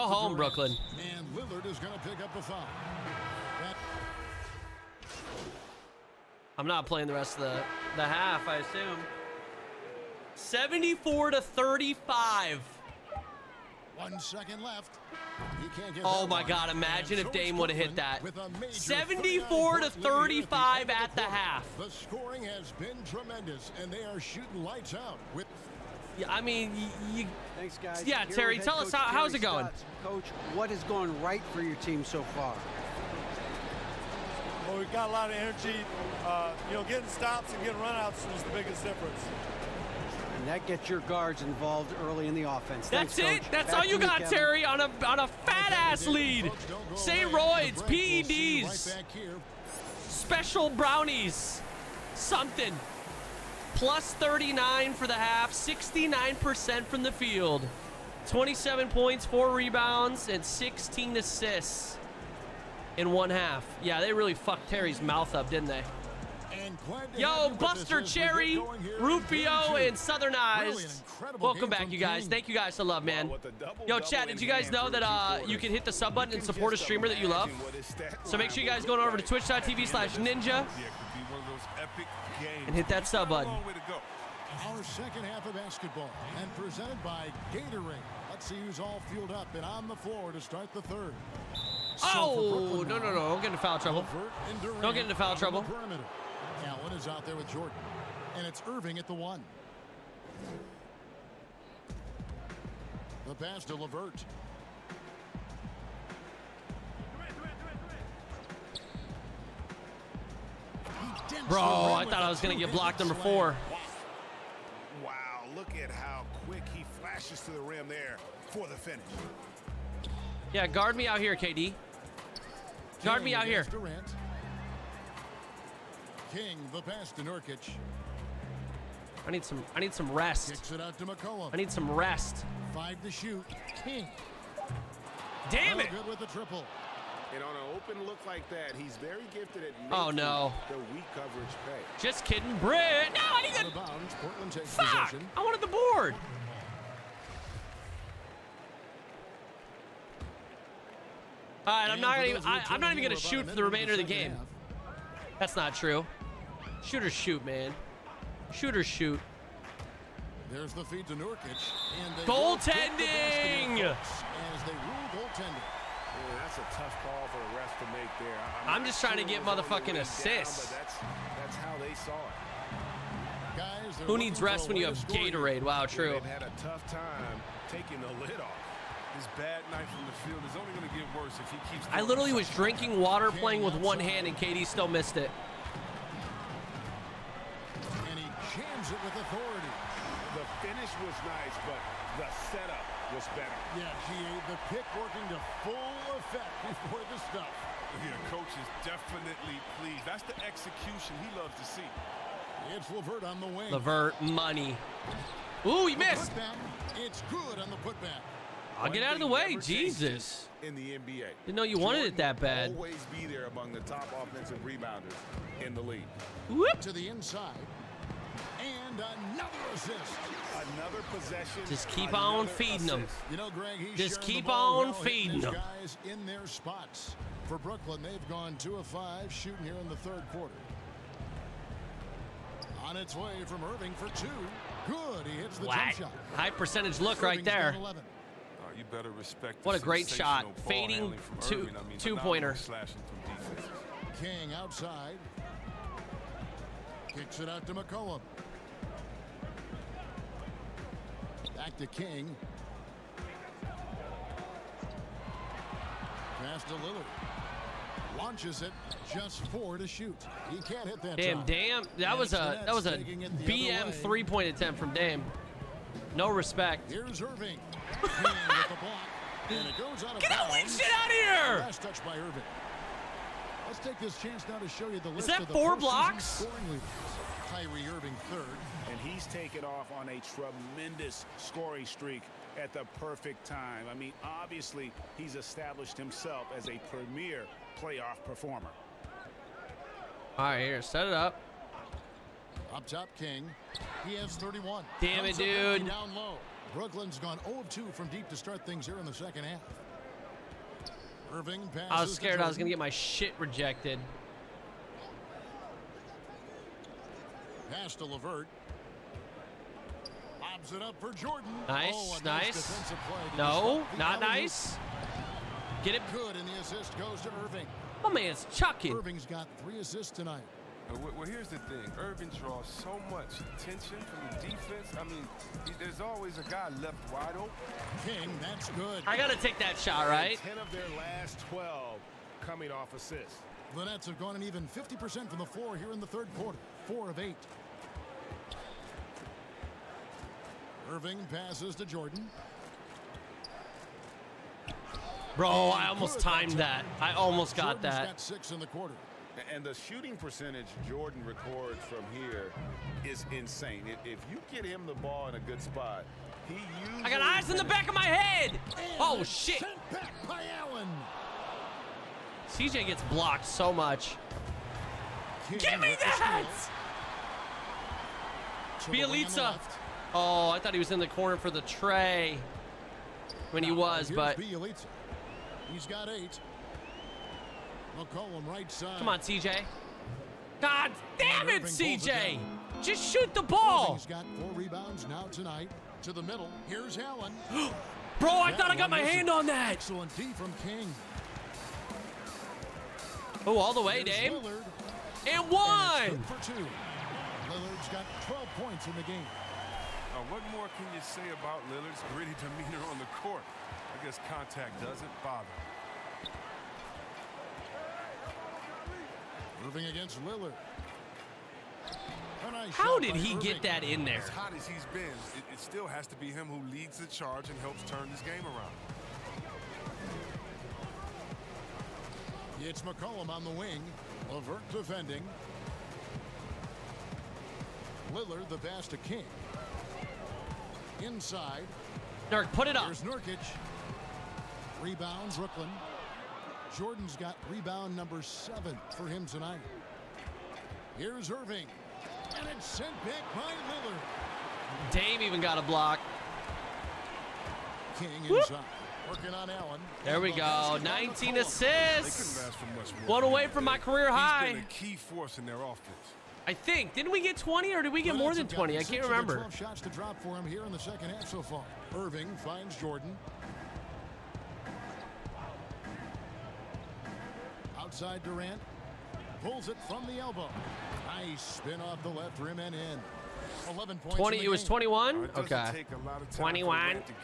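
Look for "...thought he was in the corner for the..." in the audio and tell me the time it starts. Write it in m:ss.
6:10.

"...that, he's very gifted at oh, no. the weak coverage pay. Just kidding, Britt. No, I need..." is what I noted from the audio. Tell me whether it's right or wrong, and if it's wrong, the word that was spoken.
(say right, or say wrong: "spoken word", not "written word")
right.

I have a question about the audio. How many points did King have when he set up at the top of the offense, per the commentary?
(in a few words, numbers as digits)
31.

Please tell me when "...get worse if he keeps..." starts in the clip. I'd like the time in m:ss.
3:00.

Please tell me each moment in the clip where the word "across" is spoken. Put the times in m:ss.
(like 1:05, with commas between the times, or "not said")
not said.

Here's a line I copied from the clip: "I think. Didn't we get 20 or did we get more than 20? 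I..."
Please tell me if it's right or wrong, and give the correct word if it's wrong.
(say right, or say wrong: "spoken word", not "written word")
right.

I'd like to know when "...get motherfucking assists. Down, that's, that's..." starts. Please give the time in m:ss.
2:49.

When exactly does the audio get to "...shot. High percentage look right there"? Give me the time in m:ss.
3:56.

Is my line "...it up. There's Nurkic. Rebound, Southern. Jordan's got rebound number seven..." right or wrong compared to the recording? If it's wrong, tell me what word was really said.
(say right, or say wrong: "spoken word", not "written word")
wrong: "Brooklyn", not "Southern".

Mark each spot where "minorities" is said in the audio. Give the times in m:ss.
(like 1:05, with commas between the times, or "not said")
not said.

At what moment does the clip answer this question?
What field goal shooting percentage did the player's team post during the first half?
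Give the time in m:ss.
0:55.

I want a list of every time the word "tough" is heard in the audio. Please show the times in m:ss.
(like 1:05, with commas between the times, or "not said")
2:46, 2:56.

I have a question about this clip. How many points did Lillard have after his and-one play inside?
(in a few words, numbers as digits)
12.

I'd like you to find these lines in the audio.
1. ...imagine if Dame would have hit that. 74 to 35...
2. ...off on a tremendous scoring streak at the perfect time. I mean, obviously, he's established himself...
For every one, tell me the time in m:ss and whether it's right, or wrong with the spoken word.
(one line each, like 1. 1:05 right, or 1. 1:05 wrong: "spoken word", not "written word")
1. 0:16 right
2. 4:39 right.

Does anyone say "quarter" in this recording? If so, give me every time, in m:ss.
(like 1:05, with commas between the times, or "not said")
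3:50, 5:36, 5:48.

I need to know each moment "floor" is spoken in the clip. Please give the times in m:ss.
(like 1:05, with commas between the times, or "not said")
1:29, 5:35.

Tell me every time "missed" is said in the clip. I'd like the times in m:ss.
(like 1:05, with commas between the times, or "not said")
3:04, 3:25.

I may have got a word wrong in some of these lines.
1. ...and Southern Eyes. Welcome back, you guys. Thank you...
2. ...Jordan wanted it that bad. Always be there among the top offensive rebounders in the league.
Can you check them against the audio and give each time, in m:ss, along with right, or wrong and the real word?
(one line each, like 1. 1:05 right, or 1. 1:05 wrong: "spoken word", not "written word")
1. 1:09 right
2. 3:31 right.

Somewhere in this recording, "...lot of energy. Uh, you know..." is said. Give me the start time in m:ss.
0:35.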